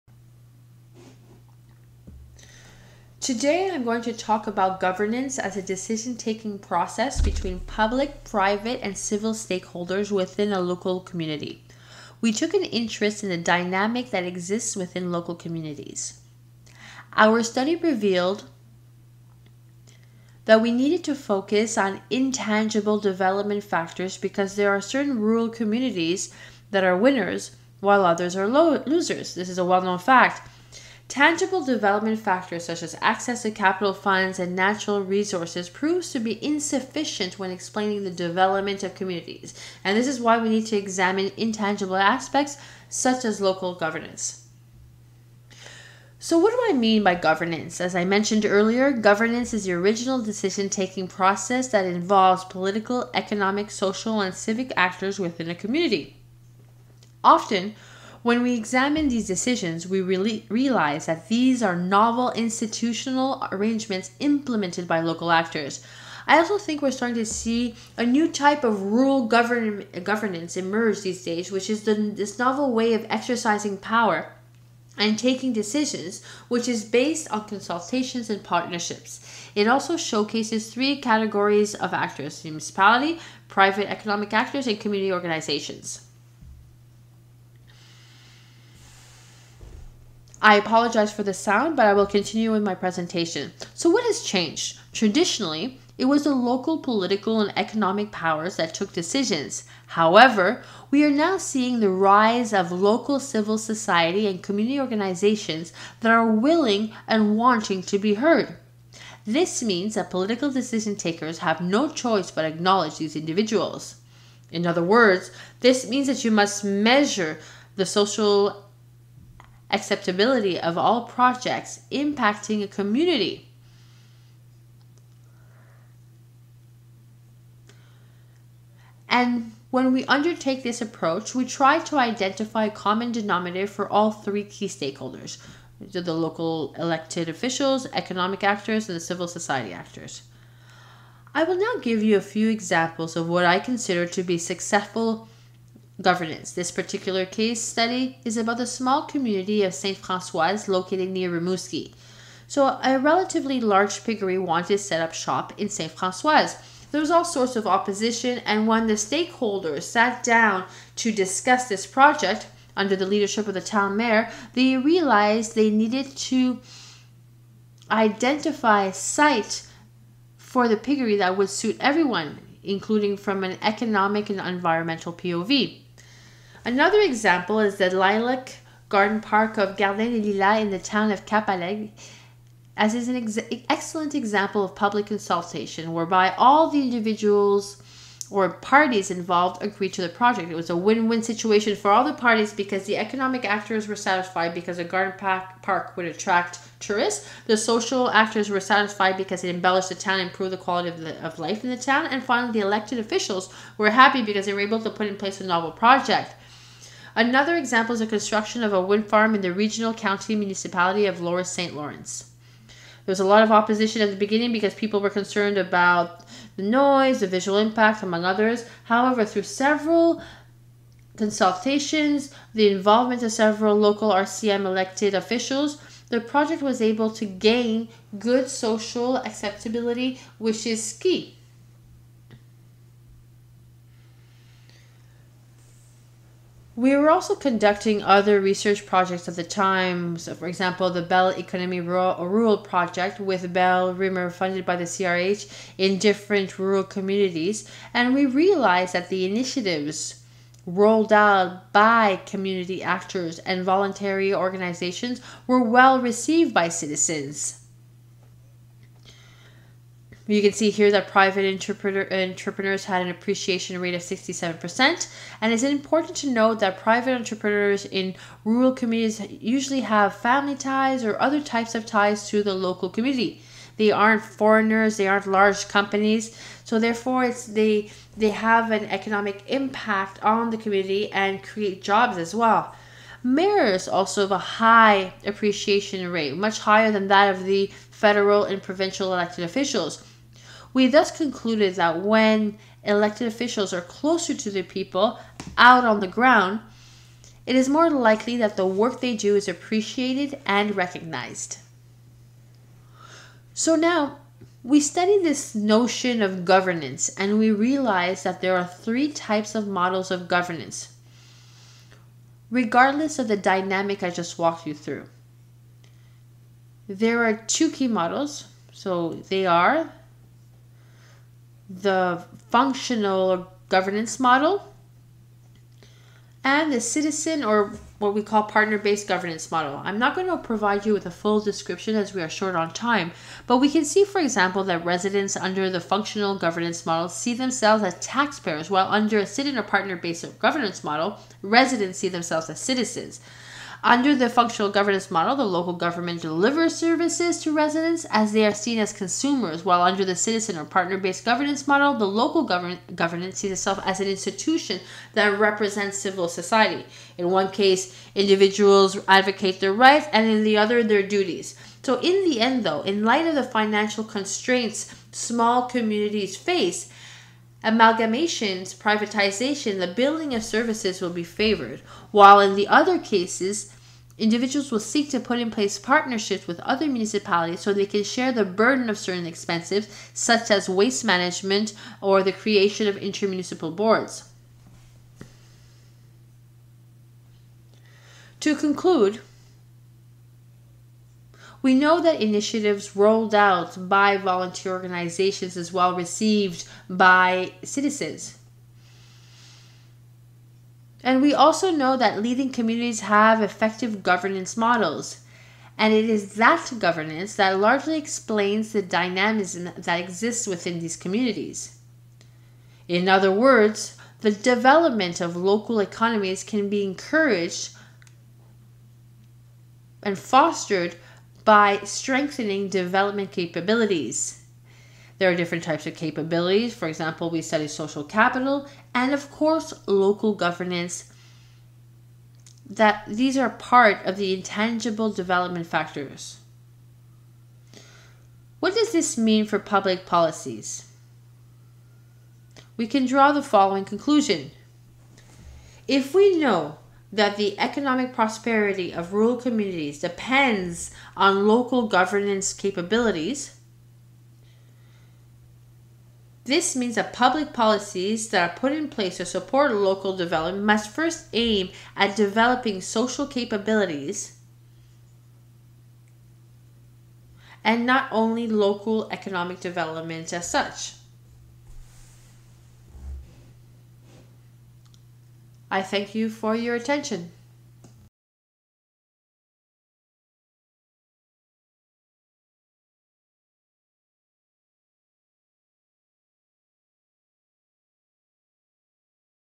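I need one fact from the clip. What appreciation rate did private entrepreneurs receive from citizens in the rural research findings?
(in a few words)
67%.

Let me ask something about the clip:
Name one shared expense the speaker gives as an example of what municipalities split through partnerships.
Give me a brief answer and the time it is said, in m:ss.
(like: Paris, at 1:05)
waste management, at 6:20.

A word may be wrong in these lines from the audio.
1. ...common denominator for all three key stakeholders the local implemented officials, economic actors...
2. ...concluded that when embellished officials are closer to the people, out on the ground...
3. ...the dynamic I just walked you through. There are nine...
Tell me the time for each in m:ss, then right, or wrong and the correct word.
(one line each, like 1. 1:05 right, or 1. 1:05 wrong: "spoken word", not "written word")
1. 2:12 wrong: "elected", not "implemented"
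2. 4:51 wrong: "elected", not "embellished"
3. 5:13 wrong: "two", not "nine".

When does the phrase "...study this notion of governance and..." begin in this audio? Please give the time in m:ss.
5:04.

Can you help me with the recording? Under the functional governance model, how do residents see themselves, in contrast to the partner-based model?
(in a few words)
as taxpayers.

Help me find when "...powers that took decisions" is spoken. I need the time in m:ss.
1:38.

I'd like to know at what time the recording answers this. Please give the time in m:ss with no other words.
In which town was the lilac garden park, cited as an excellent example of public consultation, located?
3:01.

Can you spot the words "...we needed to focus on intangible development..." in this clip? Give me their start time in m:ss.
0:20.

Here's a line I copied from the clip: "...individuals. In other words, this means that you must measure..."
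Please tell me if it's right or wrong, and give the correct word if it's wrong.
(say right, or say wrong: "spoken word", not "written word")
right.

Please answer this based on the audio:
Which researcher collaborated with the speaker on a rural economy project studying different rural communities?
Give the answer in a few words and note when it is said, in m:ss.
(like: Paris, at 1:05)
Bill Reimer, at 4:03.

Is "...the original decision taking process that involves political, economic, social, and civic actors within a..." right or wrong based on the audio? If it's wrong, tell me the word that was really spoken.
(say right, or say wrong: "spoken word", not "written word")
right.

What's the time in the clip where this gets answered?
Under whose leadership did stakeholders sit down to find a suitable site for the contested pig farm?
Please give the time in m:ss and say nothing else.
2:43.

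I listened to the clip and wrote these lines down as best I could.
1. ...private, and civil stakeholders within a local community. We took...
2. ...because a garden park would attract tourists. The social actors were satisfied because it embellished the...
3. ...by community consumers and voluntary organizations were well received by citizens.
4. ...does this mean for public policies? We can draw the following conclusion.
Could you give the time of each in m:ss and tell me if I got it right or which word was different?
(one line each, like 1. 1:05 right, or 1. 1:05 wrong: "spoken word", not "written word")
1. 0:08 right
2. 3:14 right
3. 4:11 wrong: "actors", not "consumers"
4. 7:18 right.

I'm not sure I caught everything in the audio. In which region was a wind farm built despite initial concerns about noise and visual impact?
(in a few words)
Lower St. Lawrence.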